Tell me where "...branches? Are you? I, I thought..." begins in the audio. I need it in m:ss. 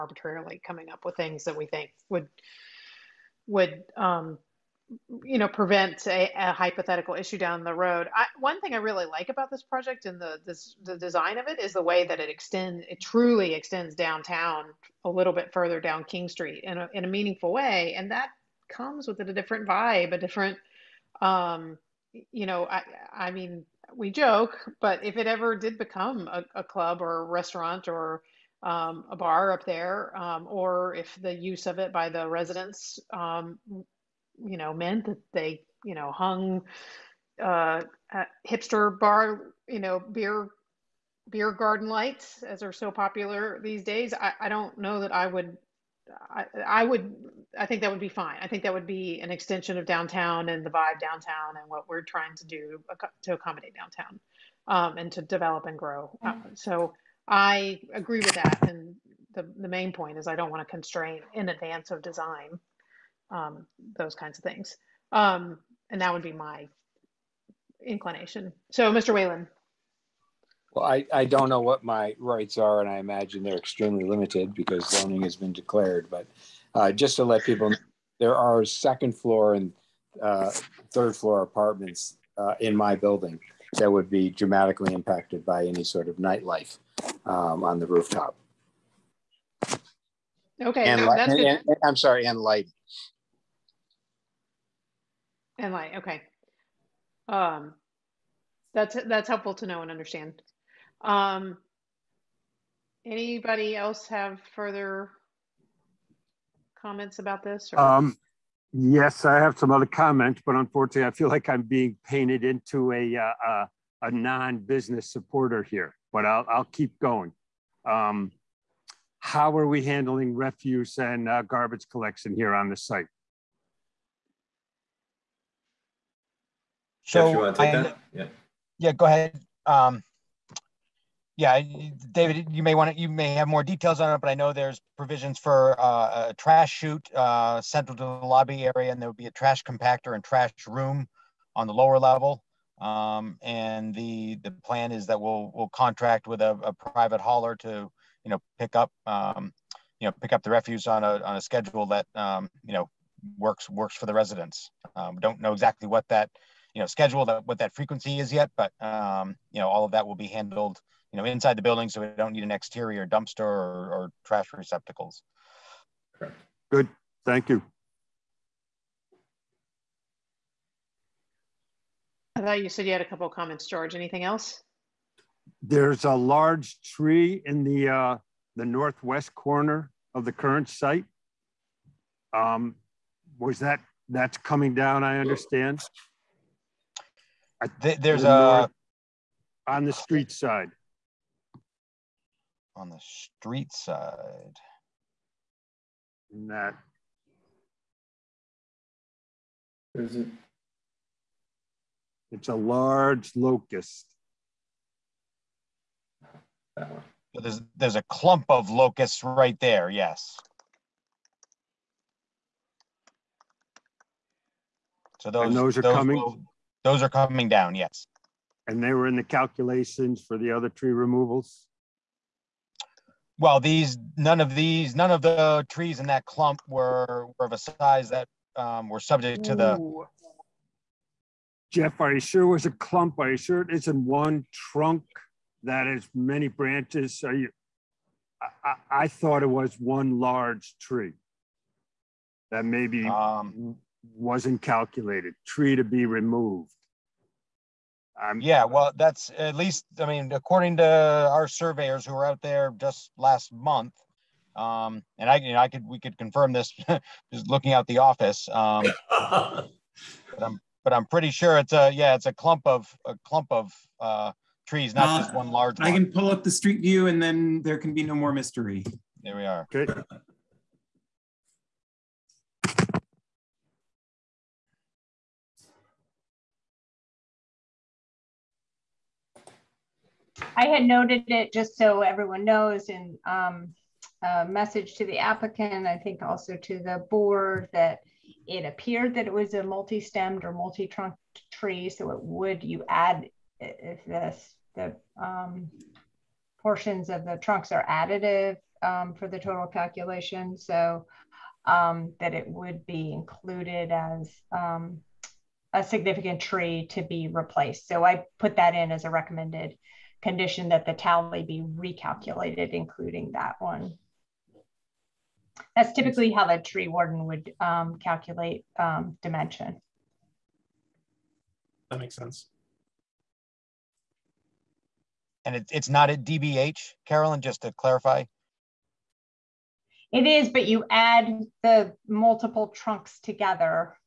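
3:56.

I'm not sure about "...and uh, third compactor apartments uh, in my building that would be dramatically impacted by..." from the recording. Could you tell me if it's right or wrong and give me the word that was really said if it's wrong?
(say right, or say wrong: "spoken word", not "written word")
wrong: "floor", not "compactor".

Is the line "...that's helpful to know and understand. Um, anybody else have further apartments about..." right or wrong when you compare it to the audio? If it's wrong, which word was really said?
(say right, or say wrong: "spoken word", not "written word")
wrong: "comments", not "apartments".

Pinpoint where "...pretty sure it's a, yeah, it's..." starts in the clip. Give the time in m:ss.
4:21.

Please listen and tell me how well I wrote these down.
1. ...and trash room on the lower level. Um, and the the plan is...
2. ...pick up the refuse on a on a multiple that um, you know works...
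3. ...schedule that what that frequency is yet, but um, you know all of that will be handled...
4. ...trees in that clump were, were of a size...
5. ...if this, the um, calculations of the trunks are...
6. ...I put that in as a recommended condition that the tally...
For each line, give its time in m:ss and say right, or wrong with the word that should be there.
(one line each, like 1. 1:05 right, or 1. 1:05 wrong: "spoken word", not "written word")
1. 2:20 right
2. 2:30 wrong: "schedule", not "multiple"
3. 2:36 right
4. 3:45 right
5. 4:53 wrong: "portions", not "calculations"
6. 5:08 right.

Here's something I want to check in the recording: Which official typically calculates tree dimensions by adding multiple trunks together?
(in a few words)
the tree warden.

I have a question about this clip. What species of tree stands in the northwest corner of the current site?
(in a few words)
locust.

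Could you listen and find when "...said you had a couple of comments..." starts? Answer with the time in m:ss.
2:52.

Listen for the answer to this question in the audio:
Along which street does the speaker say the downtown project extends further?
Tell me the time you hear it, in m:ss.
0:16.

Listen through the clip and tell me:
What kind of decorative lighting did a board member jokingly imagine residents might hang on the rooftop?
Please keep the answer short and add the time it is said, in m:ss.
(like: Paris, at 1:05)
beer garden lights, at 0:41.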